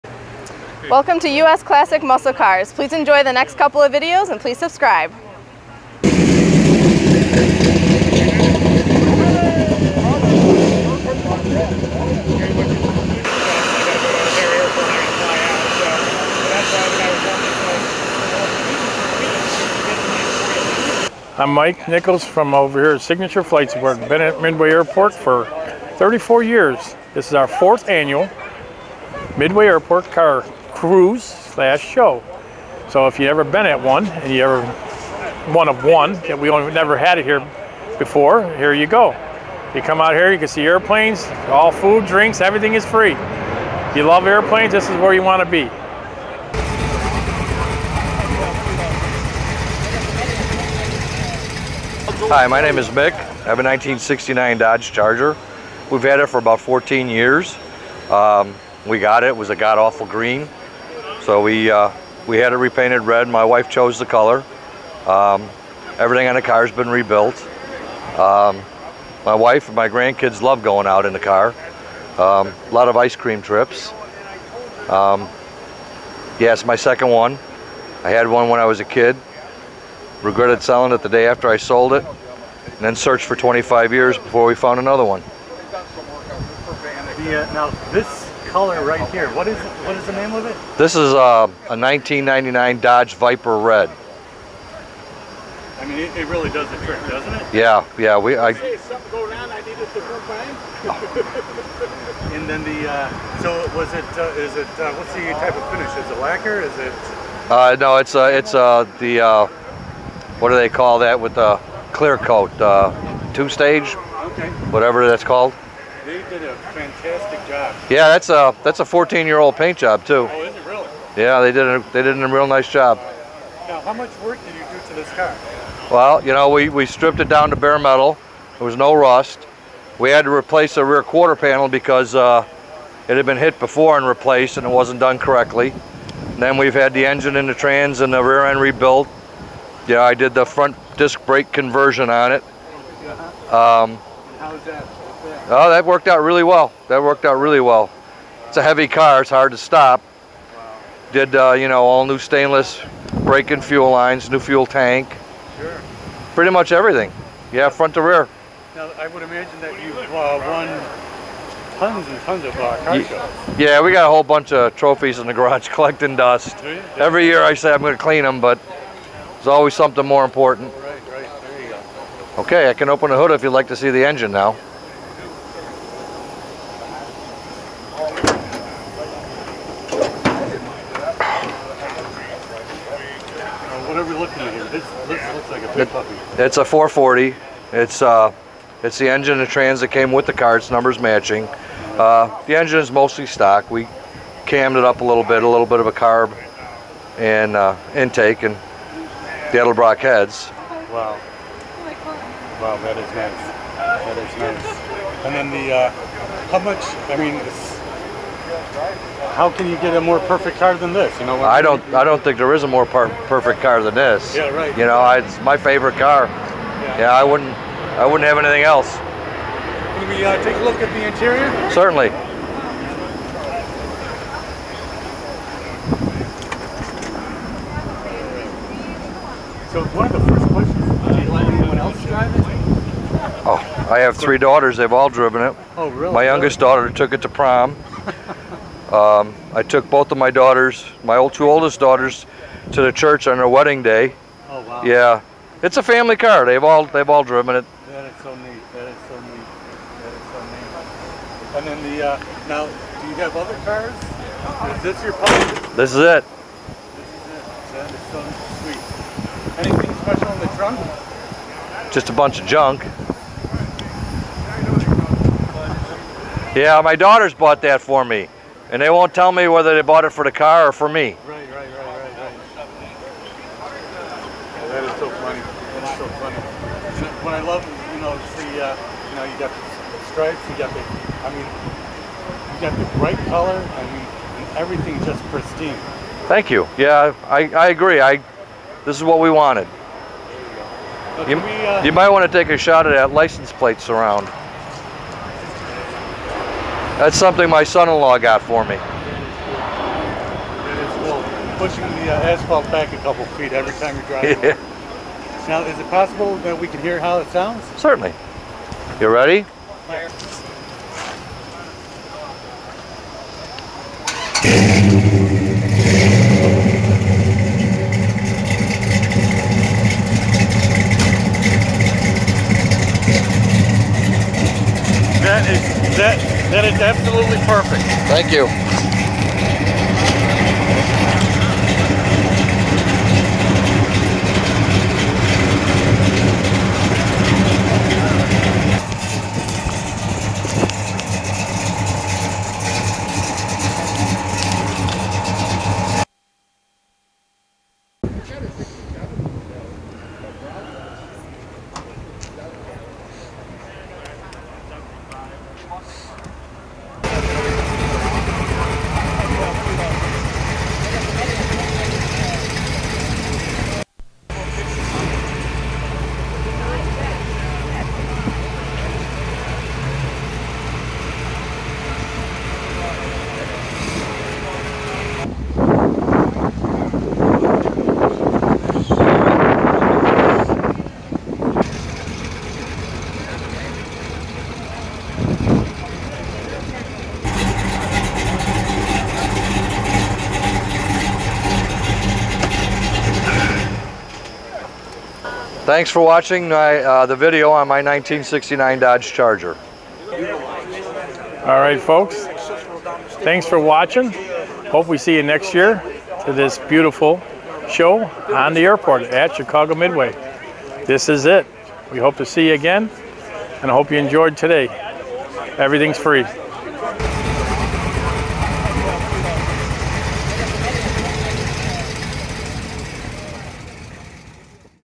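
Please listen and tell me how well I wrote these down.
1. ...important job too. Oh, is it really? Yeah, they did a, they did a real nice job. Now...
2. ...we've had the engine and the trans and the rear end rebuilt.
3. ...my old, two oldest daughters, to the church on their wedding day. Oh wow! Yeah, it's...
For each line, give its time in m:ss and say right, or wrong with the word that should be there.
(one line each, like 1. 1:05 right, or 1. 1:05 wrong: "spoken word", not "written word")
1. 1:59 wrong: "paint", not "important"
2. 2:16 right
3. 4:01 right.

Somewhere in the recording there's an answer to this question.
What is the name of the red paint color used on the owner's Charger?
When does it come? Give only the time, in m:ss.
1:31.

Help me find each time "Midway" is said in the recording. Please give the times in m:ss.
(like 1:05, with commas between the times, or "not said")
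0:24, 0:29, 6:49.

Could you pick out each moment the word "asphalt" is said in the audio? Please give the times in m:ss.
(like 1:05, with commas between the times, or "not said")
5:02.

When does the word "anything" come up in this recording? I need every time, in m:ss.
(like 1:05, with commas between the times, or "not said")
3:38, 4:19.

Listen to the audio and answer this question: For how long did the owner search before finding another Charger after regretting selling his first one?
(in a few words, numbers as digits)
25 years.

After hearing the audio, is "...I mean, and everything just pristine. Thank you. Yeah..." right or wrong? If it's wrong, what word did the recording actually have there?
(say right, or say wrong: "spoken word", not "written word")
right.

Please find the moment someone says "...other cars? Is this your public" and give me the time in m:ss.
4:13.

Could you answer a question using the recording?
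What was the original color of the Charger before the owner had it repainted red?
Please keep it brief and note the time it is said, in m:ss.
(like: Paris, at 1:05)
green, at 0:59.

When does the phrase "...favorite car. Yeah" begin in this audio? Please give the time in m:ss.
3:35.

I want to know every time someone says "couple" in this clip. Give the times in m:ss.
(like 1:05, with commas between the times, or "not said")
0:03, 5:02.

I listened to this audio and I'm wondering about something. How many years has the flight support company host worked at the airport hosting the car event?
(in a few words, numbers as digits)
34.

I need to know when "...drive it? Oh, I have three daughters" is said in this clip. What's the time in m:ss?
3:52.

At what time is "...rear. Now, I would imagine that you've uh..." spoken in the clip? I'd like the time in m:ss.
2:38.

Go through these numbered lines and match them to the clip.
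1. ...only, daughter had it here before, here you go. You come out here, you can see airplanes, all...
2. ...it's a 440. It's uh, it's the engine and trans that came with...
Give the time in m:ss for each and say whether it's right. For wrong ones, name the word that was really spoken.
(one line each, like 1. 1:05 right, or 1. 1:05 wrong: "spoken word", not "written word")
1. 0:36 wrong: "never", not "daughter"
2. 3:06 right.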